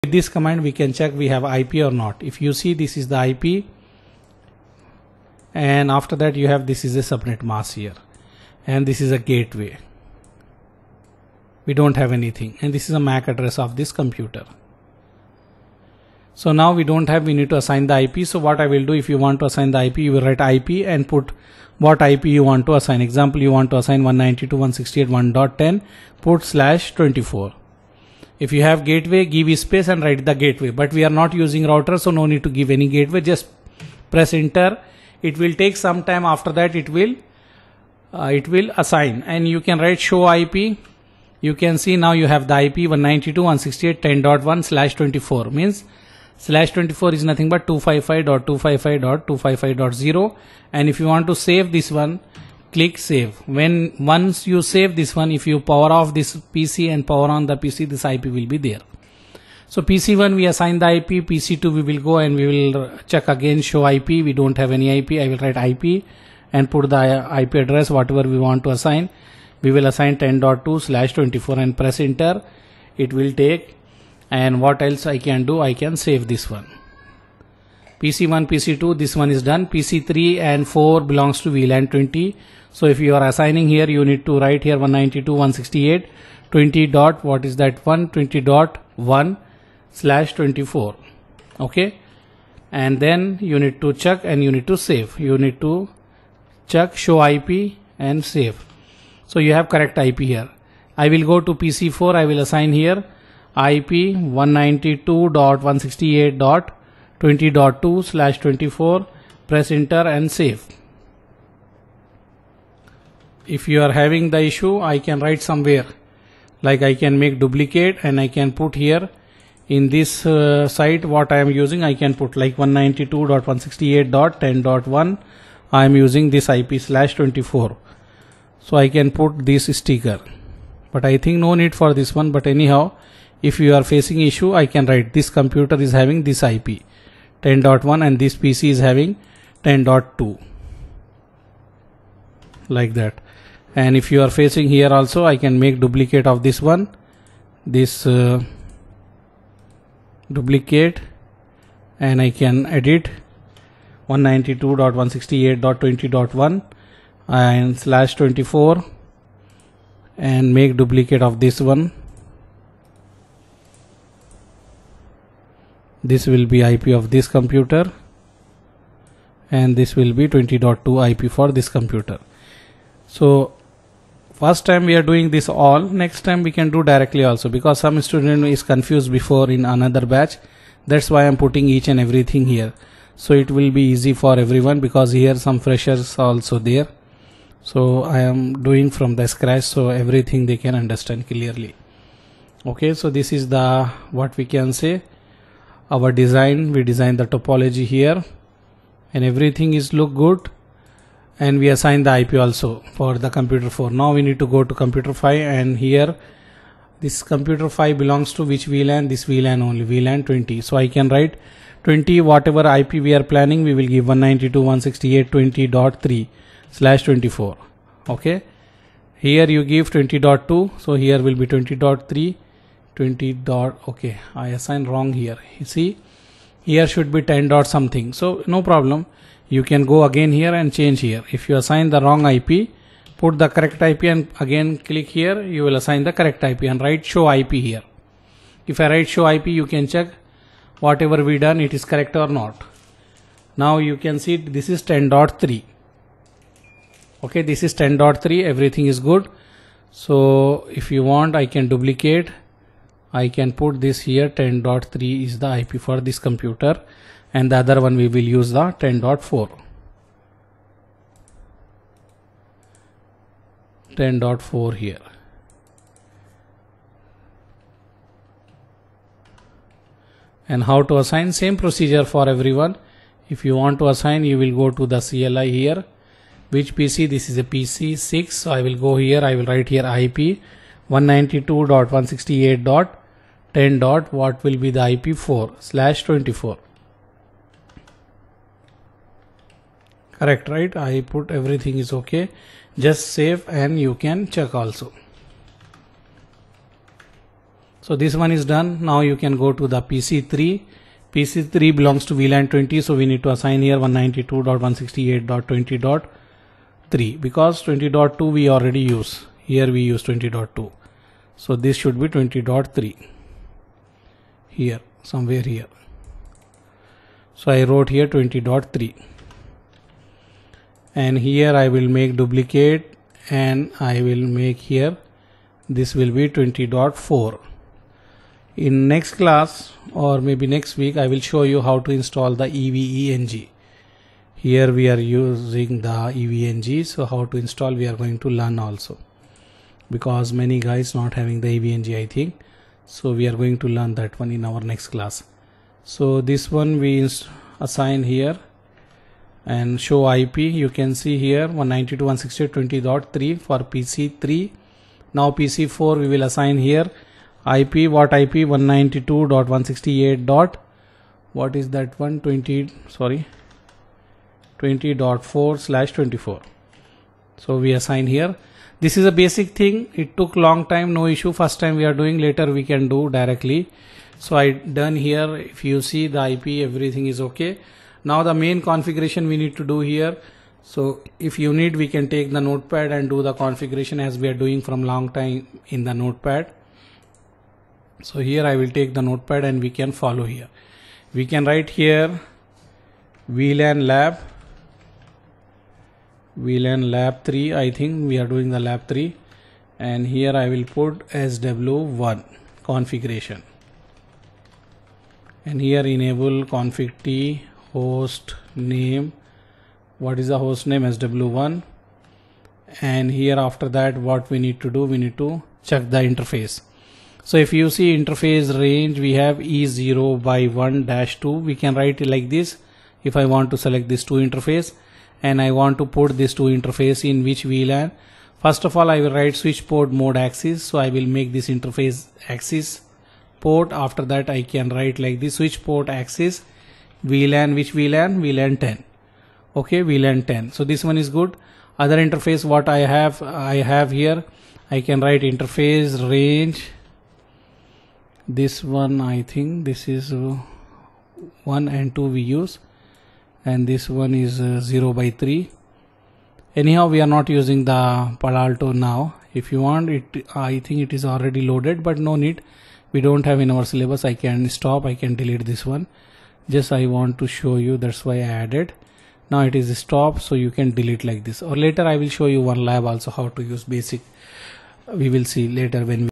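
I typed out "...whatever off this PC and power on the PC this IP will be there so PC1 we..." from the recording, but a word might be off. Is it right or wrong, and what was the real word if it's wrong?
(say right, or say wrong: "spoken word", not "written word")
wrong: "power", not "whatever".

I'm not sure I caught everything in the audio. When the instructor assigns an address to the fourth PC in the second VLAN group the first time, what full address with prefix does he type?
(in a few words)
192.168.20.2/24.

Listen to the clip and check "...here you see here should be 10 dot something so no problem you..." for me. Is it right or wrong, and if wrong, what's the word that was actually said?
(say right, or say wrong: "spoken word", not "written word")
right.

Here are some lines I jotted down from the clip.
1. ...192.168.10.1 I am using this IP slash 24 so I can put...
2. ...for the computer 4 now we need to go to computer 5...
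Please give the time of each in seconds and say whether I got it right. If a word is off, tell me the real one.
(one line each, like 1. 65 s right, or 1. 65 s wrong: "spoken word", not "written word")
1. 122 s right
2. 202 s right.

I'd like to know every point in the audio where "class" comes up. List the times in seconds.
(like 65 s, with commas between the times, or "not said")
329 s, 344 s.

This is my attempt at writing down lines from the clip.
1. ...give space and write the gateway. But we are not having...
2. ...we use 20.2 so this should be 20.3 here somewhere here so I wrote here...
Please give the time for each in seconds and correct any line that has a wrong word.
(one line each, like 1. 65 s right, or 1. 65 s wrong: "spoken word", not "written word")
1. 29 s wrong: "using", not "having"
2. 309 s right.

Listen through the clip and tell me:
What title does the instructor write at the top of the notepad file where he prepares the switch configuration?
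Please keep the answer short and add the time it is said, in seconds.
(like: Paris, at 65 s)
VLAN lab 3, at 396 s.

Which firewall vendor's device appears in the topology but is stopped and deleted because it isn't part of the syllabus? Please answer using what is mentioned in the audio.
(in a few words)
Palo Alto.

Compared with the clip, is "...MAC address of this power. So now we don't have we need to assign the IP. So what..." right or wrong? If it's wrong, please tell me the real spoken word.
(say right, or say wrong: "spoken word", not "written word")
wrong: "computer", not "power".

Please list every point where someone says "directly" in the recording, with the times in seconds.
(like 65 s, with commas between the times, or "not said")
176 s, 373 s.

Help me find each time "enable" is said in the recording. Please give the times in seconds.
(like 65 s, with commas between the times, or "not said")
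405 s.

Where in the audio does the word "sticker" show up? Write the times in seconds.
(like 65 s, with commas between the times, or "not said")
129 s.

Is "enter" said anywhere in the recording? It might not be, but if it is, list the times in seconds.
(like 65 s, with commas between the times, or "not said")
34 s, 71 s, 109 s.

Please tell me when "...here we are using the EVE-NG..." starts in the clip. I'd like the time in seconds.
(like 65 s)
334 s.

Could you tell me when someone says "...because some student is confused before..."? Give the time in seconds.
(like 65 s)
177 s.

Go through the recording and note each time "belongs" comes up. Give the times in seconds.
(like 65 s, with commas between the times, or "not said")
81 s, 207 s, 301 s.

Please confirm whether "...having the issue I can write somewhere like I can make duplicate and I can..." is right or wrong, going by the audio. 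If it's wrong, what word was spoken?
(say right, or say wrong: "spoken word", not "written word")
right.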